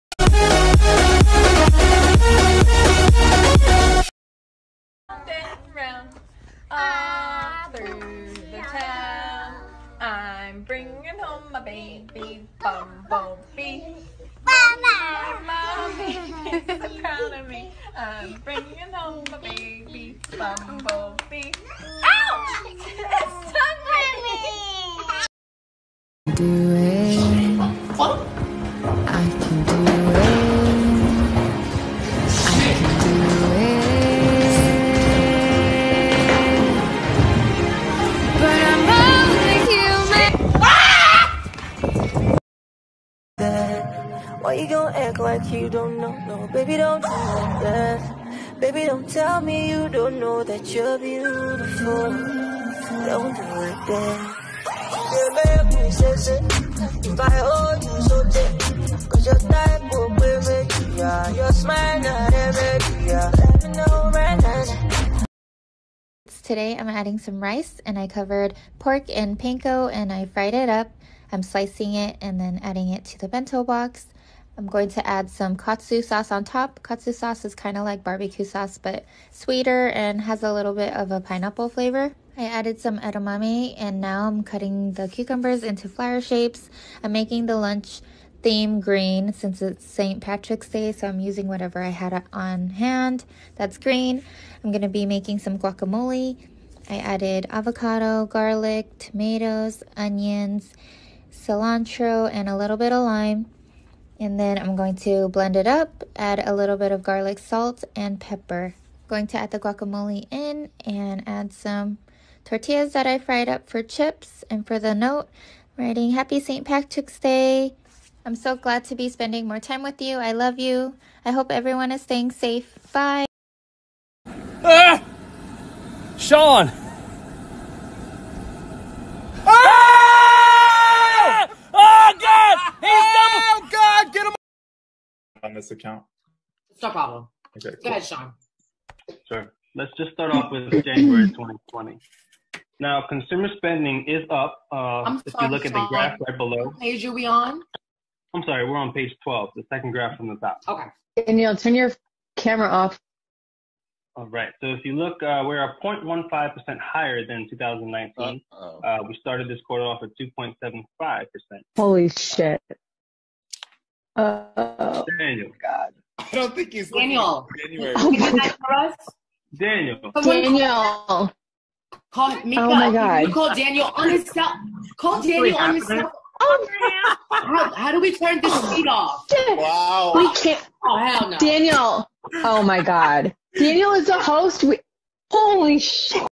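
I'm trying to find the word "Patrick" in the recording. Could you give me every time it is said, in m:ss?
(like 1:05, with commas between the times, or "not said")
1:30, 1:56.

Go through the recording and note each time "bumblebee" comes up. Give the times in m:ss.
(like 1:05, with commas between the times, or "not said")
0:12, 0:20.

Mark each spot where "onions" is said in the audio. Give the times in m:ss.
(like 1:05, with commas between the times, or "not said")
1:39.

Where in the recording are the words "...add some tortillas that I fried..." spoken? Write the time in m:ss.
1:51.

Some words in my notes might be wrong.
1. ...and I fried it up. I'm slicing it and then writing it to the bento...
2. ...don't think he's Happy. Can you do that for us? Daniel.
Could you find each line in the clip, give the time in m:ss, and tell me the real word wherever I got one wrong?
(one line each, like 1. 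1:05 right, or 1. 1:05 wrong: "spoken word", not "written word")
1. 1:09 wrong: "adding", not "writing"
2. 2:46 wrong: "Daniel", not "Happy".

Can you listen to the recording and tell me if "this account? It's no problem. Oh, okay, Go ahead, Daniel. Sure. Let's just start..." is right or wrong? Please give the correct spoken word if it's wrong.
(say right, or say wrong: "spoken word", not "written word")
wrong: "Sean", not "Daniel".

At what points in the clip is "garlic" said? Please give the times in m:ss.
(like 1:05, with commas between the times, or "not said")
1:38, 1:47.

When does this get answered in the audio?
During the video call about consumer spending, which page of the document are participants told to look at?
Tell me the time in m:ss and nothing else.
2:28.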